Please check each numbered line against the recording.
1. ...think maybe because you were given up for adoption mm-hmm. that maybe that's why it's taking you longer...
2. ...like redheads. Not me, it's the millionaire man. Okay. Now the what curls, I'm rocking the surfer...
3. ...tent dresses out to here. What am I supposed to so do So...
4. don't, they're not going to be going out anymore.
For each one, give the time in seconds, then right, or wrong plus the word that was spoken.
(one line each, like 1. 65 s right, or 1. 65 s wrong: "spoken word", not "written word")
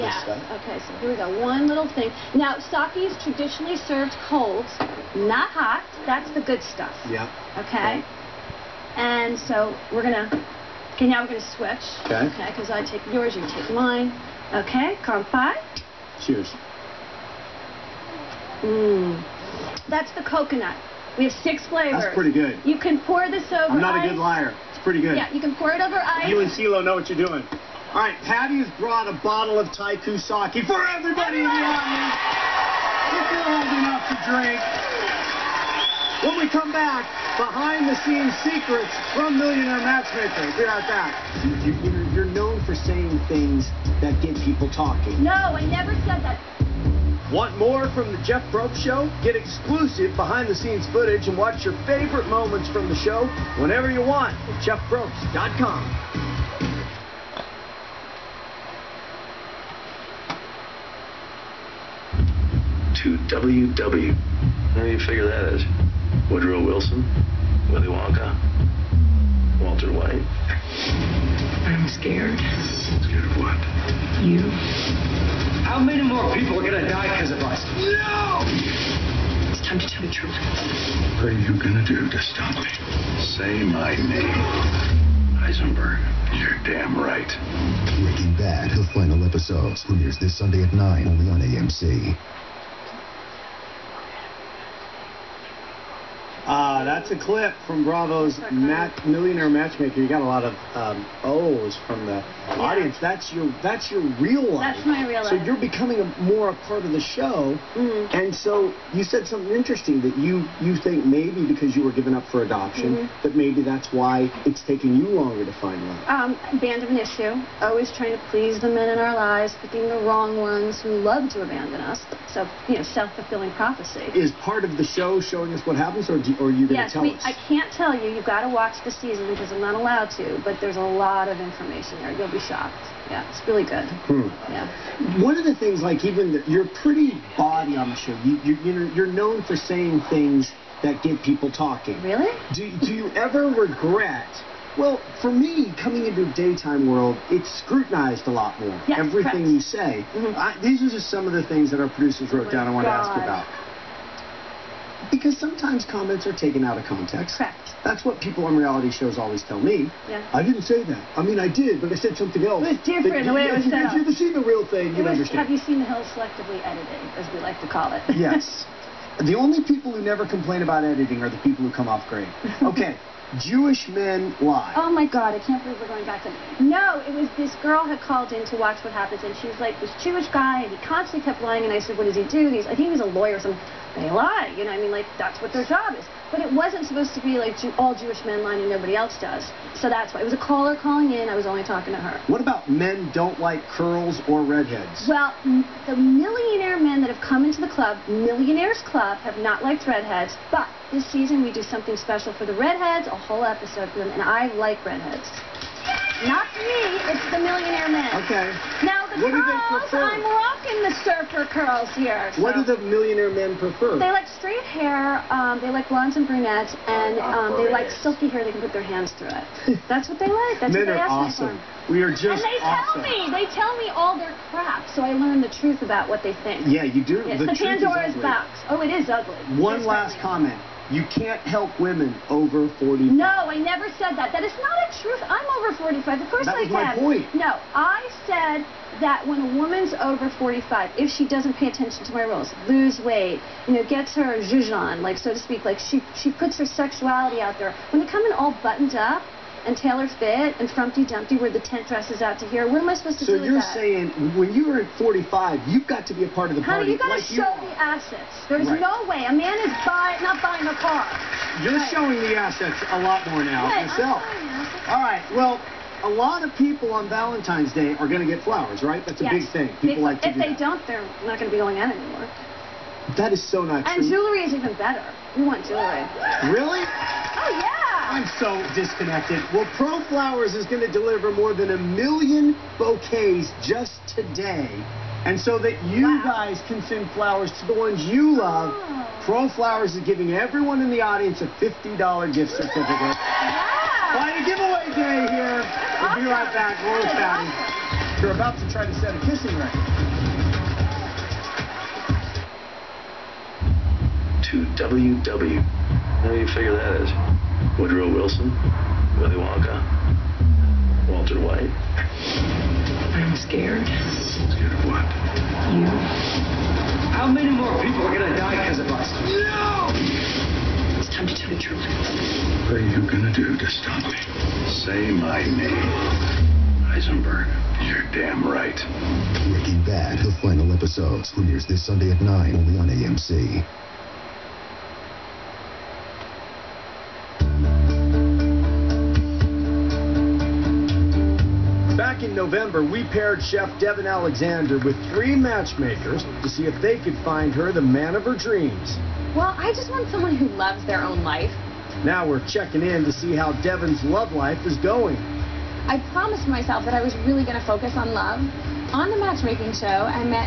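1. 110 s right
2. 204 s right
3. 251 s right
4. 270 s right.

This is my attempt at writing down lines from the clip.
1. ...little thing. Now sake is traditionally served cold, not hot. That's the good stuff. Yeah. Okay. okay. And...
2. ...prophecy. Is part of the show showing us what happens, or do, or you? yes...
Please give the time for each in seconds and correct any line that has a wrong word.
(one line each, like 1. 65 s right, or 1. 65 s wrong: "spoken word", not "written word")
1. 1 s right
2. 123 s right.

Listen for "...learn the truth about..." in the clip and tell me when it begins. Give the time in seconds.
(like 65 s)
225 s.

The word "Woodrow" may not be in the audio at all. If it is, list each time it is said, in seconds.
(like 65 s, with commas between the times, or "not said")
66 s, 307 s.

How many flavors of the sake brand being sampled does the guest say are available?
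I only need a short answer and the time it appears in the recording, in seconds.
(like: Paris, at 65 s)
6, at 21 s.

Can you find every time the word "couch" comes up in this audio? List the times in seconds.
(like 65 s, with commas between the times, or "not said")
not said.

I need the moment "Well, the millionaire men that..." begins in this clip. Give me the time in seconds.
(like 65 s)
195 s.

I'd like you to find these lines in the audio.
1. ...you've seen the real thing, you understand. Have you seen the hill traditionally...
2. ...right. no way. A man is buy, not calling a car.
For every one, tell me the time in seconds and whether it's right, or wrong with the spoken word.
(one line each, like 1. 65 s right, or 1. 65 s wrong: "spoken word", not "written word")
1. 164 s wrong: "selectively", not "traditionally"
2. 258 s wrong: "buying", not "calling".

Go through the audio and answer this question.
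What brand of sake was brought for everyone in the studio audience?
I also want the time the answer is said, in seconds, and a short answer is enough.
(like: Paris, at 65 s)
TYKU, at 29 s.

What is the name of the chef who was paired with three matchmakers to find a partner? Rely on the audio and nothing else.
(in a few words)
Devin Alexander.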